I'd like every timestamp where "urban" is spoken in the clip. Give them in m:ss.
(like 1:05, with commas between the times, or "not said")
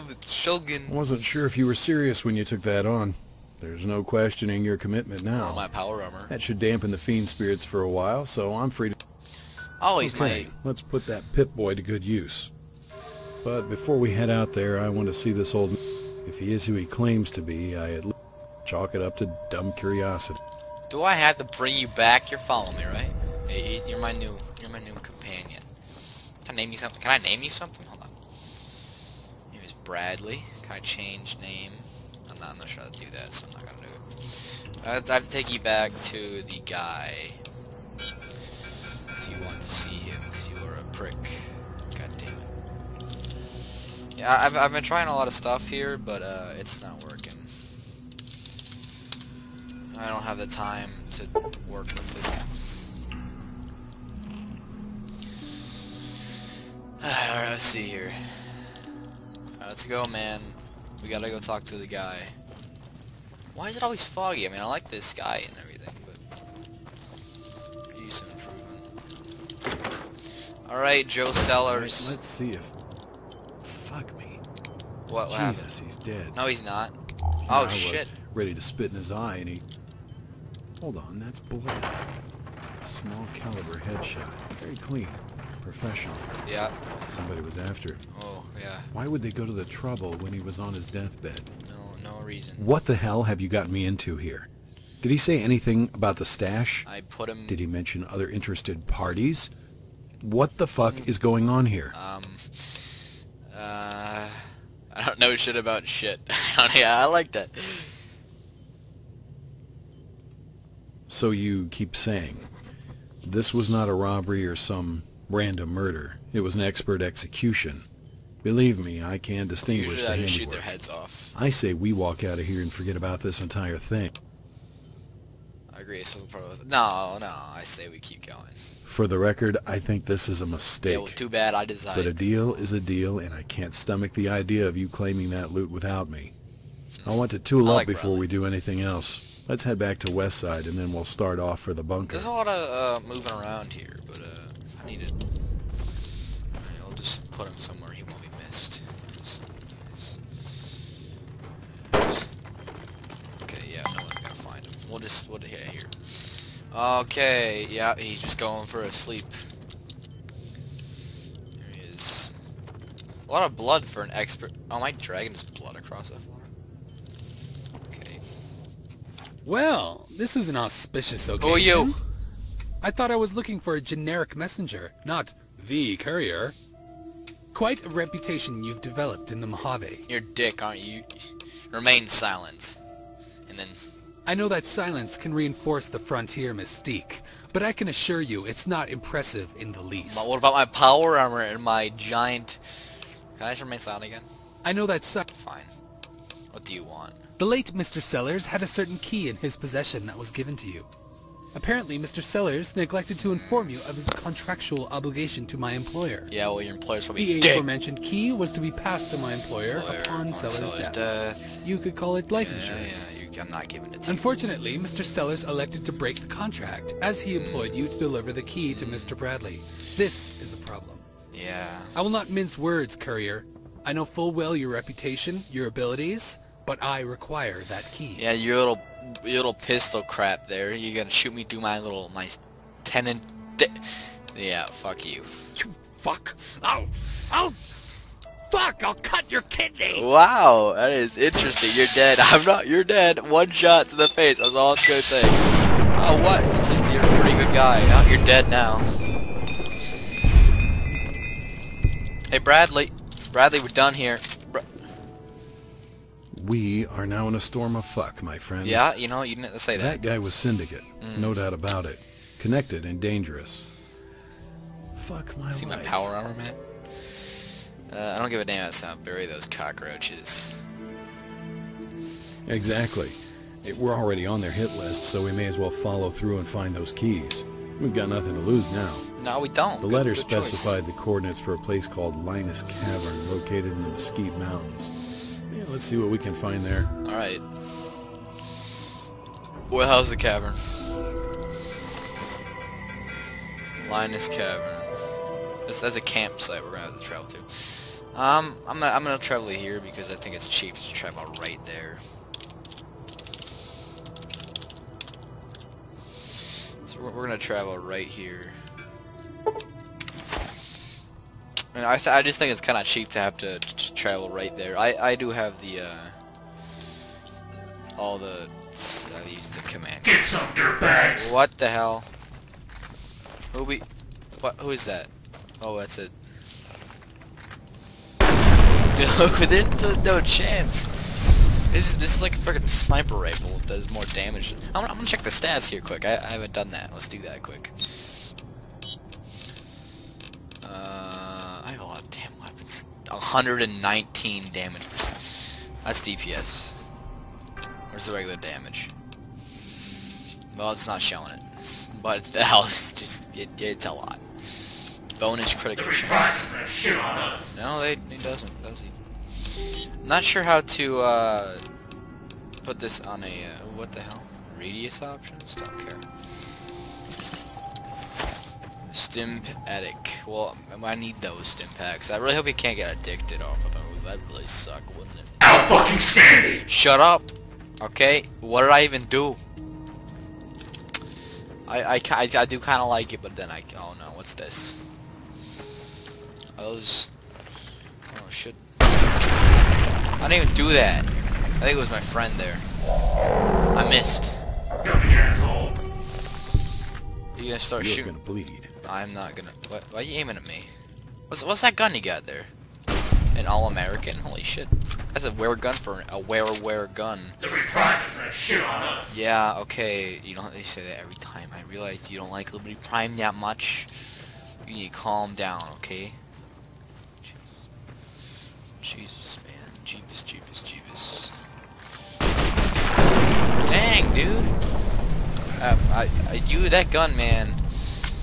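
not said.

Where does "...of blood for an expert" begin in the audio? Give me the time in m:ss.
2:43.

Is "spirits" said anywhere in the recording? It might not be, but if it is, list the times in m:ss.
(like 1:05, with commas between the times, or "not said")
0:07.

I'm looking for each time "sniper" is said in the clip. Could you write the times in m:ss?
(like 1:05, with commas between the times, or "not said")
5:32.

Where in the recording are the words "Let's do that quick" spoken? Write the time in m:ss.
5:36.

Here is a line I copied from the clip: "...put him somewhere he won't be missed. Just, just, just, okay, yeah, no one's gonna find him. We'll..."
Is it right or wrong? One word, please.
right.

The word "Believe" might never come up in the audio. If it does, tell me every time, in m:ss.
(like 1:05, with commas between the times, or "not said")
1:58.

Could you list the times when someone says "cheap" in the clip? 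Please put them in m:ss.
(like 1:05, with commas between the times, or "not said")
5:00, 5:12.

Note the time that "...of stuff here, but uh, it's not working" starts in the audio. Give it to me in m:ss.
0:45.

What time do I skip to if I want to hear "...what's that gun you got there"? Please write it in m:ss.
6:41.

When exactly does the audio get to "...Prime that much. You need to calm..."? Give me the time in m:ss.
6:52.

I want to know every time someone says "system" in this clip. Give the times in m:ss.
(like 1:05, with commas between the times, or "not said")
not said.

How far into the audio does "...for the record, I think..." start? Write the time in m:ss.
2:08.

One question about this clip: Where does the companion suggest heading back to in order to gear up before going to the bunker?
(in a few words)
Westside.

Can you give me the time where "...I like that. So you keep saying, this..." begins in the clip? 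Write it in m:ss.
1:47.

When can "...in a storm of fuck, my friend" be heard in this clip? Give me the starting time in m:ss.
4:17.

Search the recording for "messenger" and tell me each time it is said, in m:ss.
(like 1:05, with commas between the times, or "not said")
2:54.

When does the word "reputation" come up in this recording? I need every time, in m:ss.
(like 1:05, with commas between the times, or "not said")
2:57, 3:44.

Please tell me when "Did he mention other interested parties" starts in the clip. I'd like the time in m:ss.
1:37.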